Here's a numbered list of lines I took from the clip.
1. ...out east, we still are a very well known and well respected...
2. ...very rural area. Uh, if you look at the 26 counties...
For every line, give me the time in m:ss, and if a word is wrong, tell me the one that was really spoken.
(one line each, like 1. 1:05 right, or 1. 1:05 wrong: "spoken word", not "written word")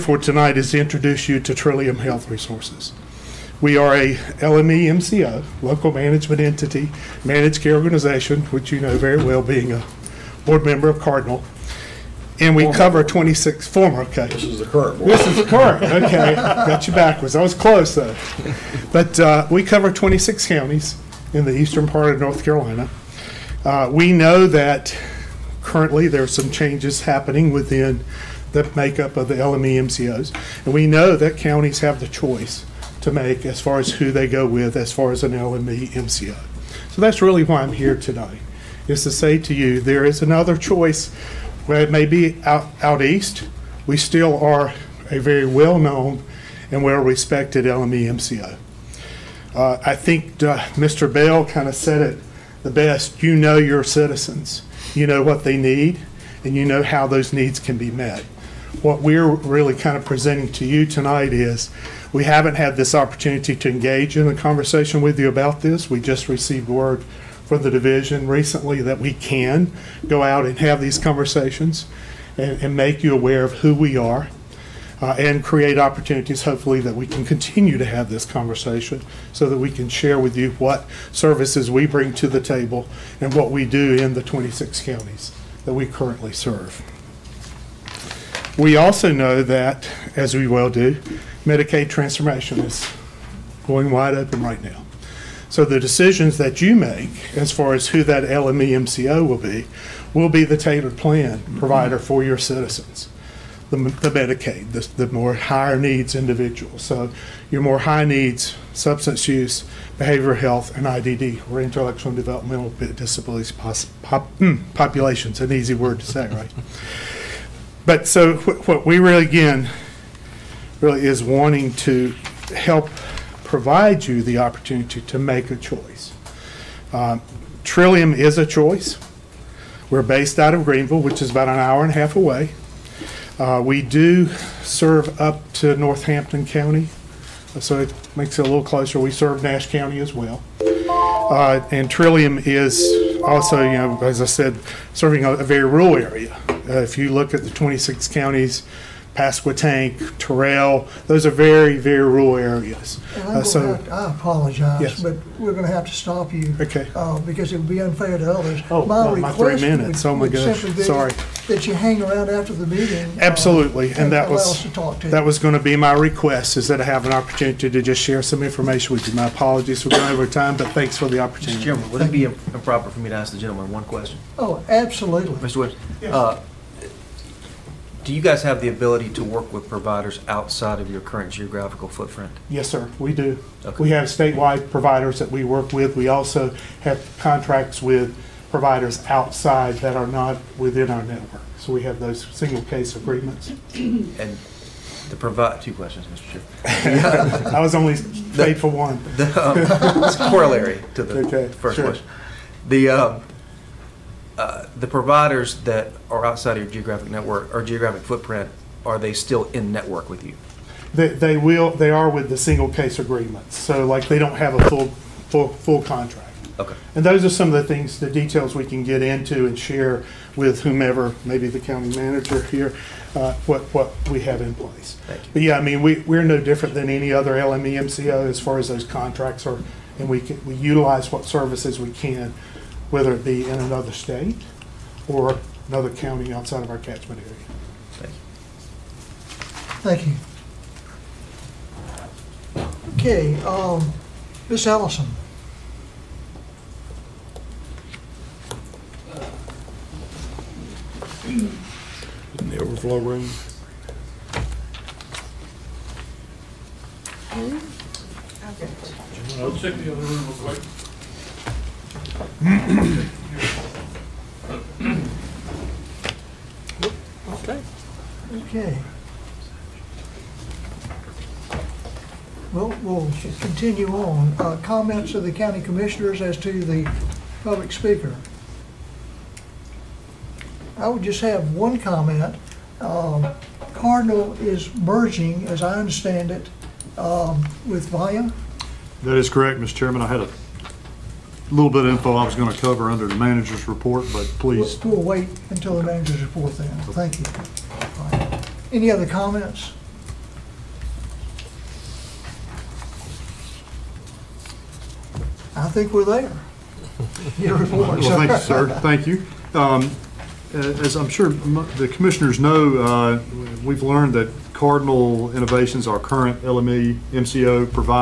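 1. 0:42 right
2. 2:25 right.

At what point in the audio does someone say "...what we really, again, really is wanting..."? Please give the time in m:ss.
1:58.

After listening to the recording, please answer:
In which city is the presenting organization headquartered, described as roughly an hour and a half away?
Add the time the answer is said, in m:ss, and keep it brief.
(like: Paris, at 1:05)
Greenville, at 2:10.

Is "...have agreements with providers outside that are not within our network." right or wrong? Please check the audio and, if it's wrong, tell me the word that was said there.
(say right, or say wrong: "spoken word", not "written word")
wrong: "contracts", not "agreements".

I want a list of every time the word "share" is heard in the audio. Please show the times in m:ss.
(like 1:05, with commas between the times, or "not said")
1:19, 2:48, 3:39.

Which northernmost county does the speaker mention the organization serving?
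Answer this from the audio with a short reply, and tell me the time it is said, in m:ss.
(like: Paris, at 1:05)
Northampton County, at 2:15.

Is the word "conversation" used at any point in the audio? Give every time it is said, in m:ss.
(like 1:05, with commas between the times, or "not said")
1:04, 1:10, 1:18.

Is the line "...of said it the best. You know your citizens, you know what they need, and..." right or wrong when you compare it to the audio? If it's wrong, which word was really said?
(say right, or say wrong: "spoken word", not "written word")
right.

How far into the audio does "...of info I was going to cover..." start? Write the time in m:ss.
4:51.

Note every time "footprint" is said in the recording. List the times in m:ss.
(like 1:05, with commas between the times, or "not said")
3:01, 3:28.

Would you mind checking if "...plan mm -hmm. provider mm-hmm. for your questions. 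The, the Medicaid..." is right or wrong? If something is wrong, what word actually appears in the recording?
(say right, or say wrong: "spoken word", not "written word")
wrong: "citizens", not "questions".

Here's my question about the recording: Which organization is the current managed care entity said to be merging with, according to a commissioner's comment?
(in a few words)
Vaya.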